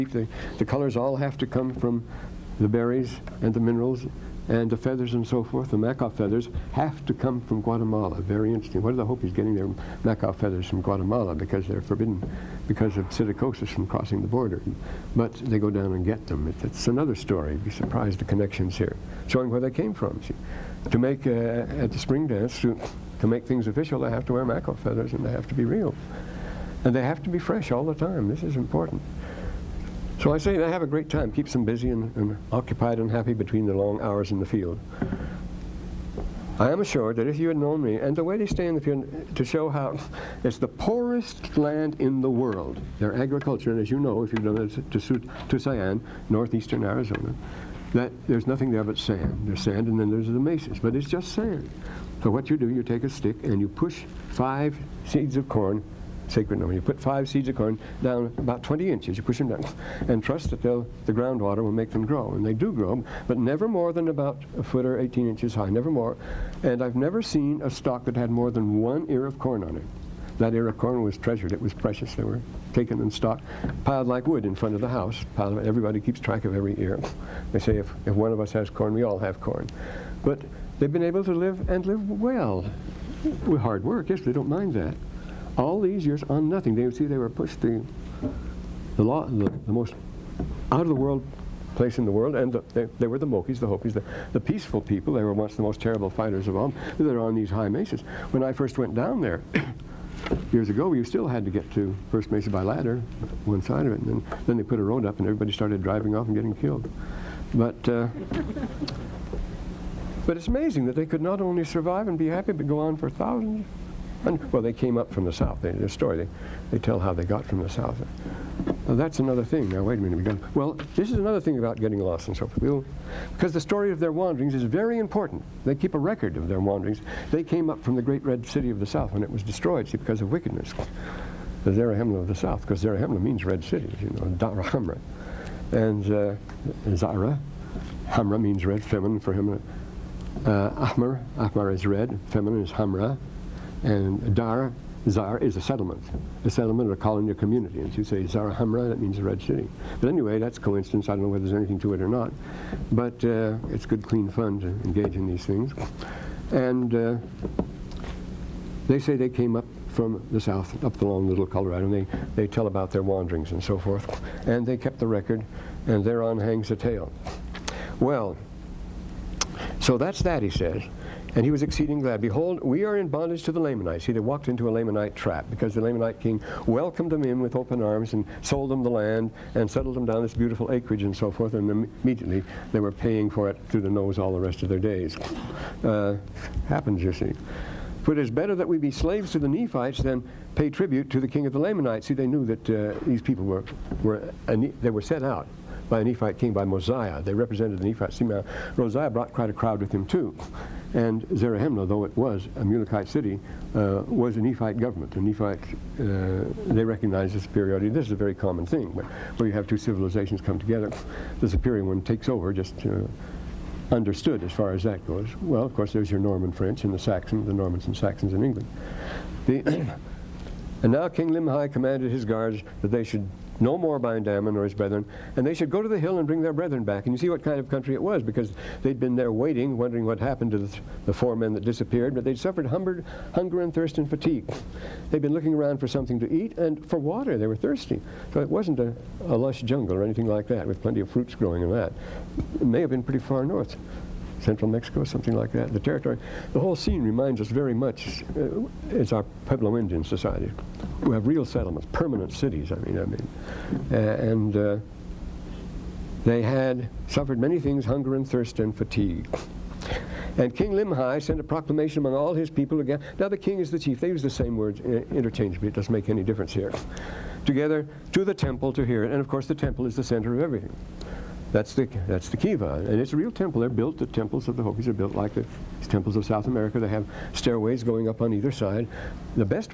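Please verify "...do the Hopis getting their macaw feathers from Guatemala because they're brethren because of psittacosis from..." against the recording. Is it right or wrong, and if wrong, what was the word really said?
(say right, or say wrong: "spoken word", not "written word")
wrong: "forbidden", not "brethren".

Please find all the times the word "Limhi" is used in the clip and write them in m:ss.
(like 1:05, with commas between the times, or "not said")
3:41, 4:20.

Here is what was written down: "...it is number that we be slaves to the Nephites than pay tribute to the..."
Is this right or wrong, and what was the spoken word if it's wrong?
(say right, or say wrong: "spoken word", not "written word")
wrong: "better", not "number".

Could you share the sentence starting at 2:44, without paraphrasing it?
And they kept the record, and thereon hangs the tale.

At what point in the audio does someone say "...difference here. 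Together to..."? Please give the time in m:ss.
4:26.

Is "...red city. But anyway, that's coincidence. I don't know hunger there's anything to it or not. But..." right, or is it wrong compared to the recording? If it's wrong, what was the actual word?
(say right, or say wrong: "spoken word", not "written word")
wrong: "whether", not "hunger".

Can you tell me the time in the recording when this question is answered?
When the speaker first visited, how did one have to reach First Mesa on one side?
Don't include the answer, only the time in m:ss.
1:42.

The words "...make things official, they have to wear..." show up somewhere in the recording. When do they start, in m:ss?
0:23.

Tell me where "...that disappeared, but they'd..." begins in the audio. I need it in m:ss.
3:51.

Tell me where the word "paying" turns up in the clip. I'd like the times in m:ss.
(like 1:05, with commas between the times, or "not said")
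3:02.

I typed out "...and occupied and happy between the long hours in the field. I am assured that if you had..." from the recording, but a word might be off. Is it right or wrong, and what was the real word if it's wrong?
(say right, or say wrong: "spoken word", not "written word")
right.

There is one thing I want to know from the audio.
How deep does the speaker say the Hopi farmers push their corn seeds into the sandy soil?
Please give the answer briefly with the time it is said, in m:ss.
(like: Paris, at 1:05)
20 inches, at 0:58.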